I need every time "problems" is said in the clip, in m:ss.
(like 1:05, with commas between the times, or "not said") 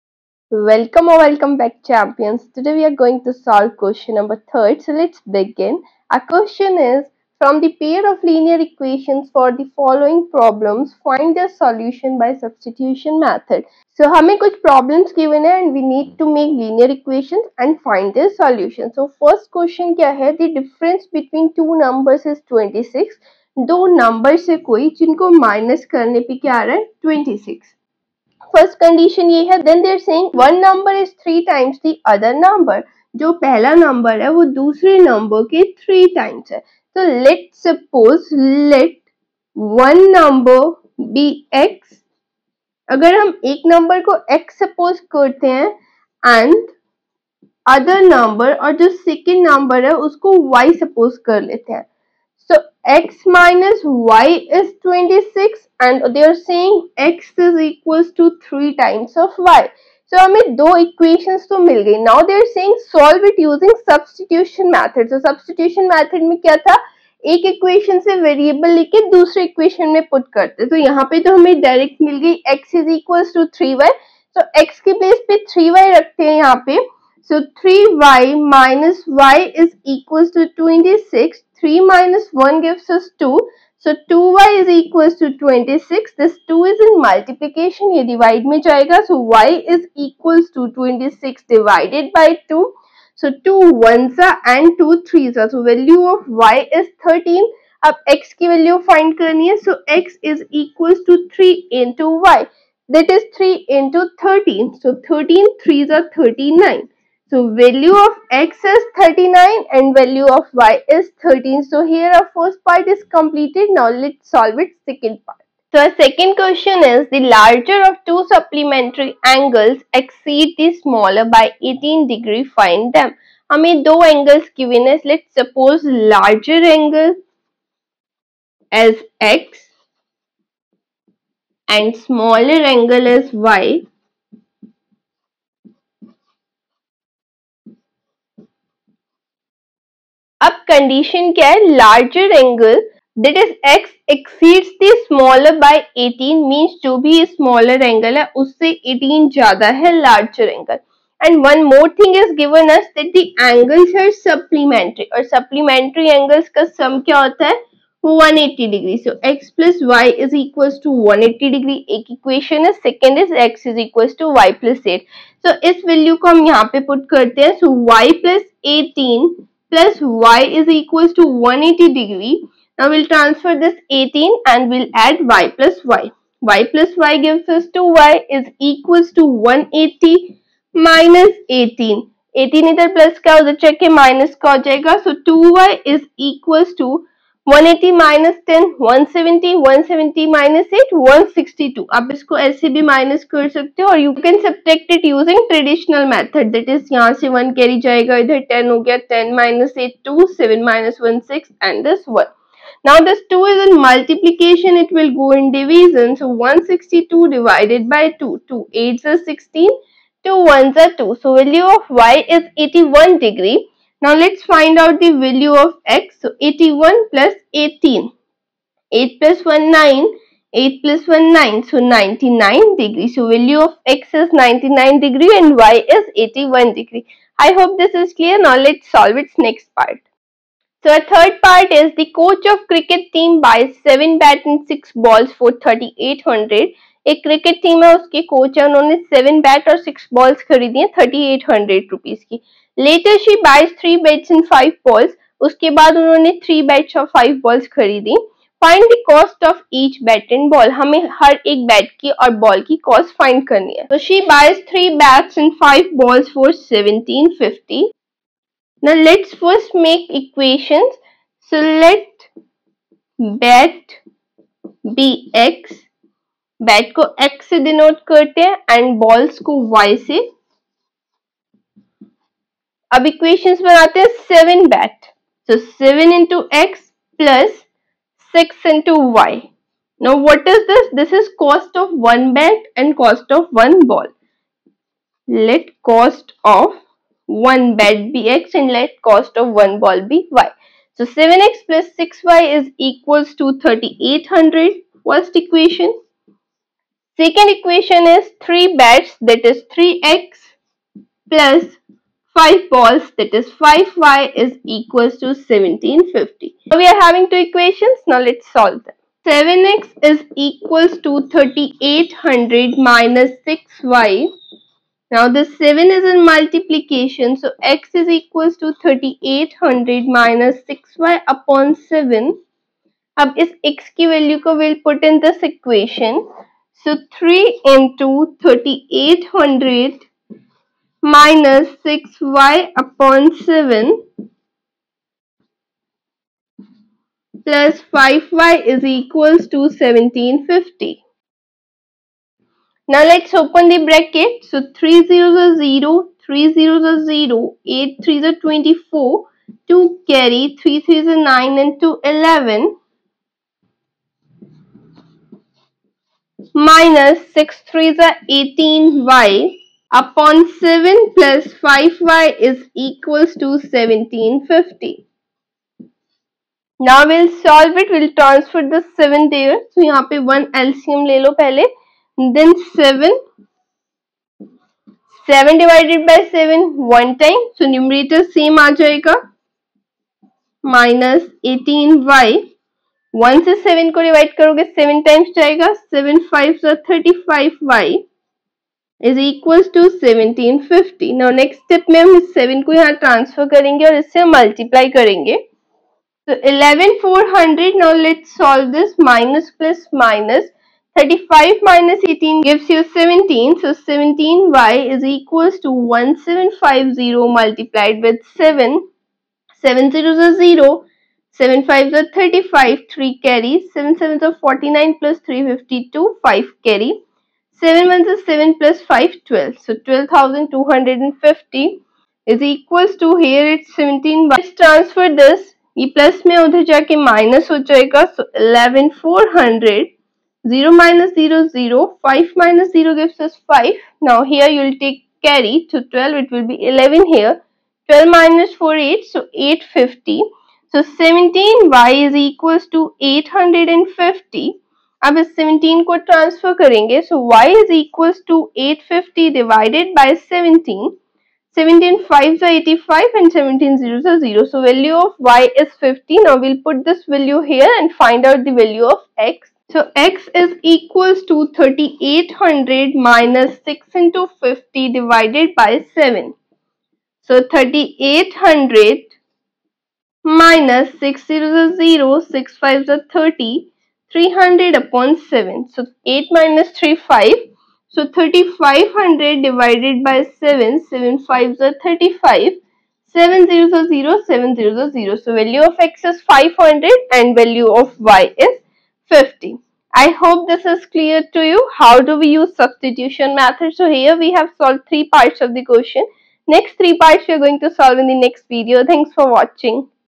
0:10, 0:14.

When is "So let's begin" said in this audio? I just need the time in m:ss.
0:04.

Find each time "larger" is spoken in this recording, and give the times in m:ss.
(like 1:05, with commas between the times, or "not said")
1:57, 2:05.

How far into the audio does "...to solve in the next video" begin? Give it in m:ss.
8:17.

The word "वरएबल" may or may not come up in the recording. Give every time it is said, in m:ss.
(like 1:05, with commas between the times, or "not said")
1:08.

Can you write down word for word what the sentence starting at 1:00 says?
So हमें दो equations to mil gayi Now they are saying solve it using substitution method.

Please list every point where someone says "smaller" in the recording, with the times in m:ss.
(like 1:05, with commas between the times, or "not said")
2:00, 2:11.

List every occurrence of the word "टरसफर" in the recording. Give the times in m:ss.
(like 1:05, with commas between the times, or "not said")
6:33, 7:26.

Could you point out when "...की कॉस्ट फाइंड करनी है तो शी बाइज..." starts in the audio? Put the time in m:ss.
4:12.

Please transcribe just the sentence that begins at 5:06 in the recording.
So we are having two equations.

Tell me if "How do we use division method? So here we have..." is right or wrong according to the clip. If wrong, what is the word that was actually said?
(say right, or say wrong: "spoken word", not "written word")
wrong: "substitution", not "division".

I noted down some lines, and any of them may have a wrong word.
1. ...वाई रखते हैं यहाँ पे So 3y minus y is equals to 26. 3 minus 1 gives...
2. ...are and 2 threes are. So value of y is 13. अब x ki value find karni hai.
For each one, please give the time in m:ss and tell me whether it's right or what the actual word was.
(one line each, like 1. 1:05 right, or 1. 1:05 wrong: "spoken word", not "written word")
1. 1:15 right
2. 1:34 right.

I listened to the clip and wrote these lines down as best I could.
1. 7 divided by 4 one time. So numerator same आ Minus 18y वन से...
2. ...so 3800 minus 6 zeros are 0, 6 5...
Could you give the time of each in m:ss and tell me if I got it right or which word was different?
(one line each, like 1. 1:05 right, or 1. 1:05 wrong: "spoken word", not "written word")
1. 6:15 wrong: "7", not "4"
2. 7:47 right.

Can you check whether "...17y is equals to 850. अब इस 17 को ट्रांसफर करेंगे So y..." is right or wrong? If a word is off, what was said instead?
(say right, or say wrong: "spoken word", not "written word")
right.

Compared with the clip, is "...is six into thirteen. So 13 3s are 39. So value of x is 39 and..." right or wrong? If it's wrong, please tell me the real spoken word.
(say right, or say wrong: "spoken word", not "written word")
wrong: "three", not "six".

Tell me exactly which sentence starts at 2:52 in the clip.
Now we'll transfer this 18 and we'll add y plus y.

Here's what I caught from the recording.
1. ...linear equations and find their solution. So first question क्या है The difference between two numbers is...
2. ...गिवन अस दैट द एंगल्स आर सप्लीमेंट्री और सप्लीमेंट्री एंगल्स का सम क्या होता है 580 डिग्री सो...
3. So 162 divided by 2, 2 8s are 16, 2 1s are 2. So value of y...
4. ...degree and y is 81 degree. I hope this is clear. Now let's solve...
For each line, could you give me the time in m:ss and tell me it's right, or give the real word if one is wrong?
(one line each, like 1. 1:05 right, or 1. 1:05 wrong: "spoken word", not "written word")
1. 0:16 right
2. 2:32 wrong: "180", not "580"
3. 3:26 right
4. 3:44 right.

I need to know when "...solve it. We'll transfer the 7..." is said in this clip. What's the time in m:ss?
6:07.